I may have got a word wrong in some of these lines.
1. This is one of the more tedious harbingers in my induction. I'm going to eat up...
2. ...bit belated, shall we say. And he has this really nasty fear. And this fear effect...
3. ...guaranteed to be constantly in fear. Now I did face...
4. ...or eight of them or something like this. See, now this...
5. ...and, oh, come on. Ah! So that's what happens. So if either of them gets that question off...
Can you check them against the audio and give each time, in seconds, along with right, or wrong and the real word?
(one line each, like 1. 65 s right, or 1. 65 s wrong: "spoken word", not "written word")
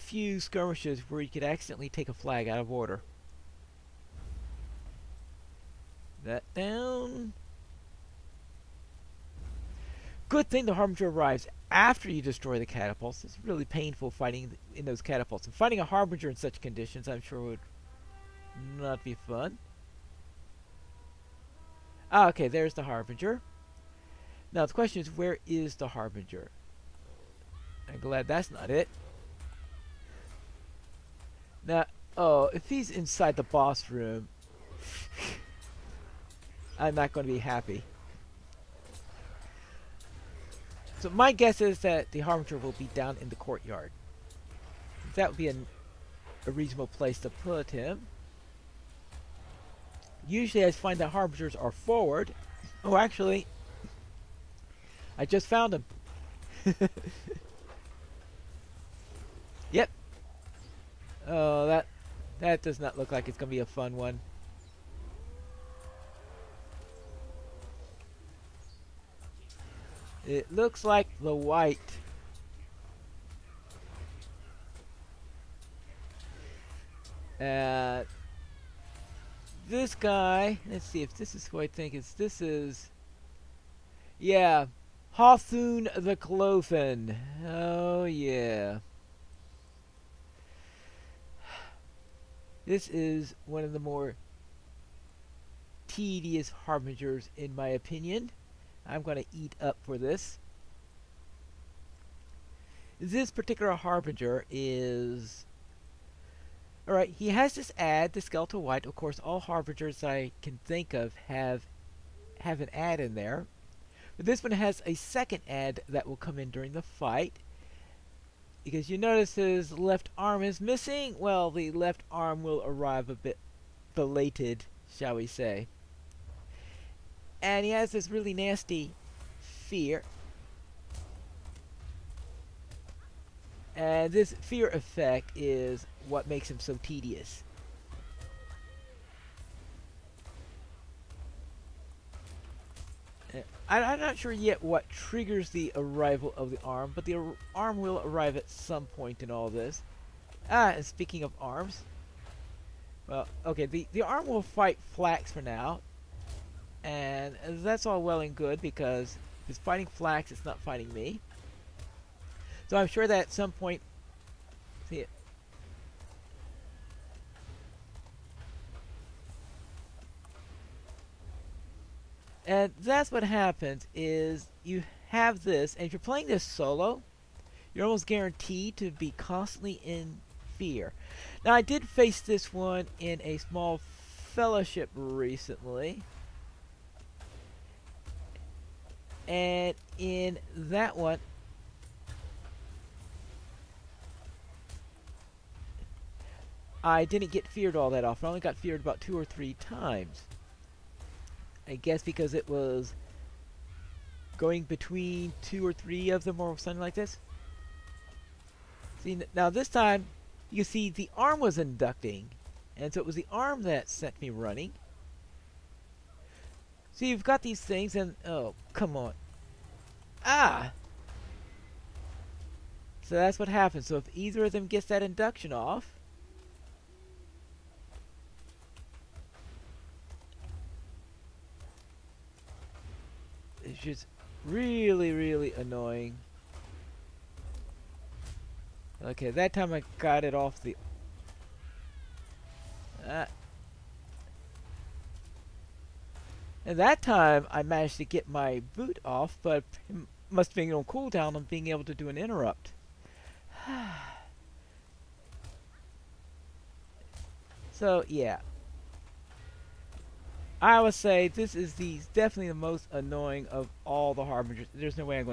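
1. 92 s wrong: "opinion", not "induction"
2. 123 s right
3. 178 s right
4. 205 s wrong: "three", not "eight"
5. 217 s wrong: "induction", not "question".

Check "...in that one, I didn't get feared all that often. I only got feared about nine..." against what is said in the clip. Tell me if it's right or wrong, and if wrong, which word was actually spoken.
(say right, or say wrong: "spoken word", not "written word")
wrong: "two", not "nine".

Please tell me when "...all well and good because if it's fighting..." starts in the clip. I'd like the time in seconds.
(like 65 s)
157 s.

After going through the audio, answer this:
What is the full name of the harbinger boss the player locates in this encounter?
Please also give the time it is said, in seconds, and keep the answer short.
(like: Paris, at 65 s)
Hawthorne the Cloven, at 85 s.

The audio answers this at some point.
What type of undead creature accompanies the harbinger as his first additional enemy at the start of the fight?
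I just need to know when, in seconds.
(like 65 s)
108 s.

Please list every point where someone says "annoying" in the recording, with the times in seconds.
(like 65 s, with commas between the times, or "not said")
235 s, 262 s.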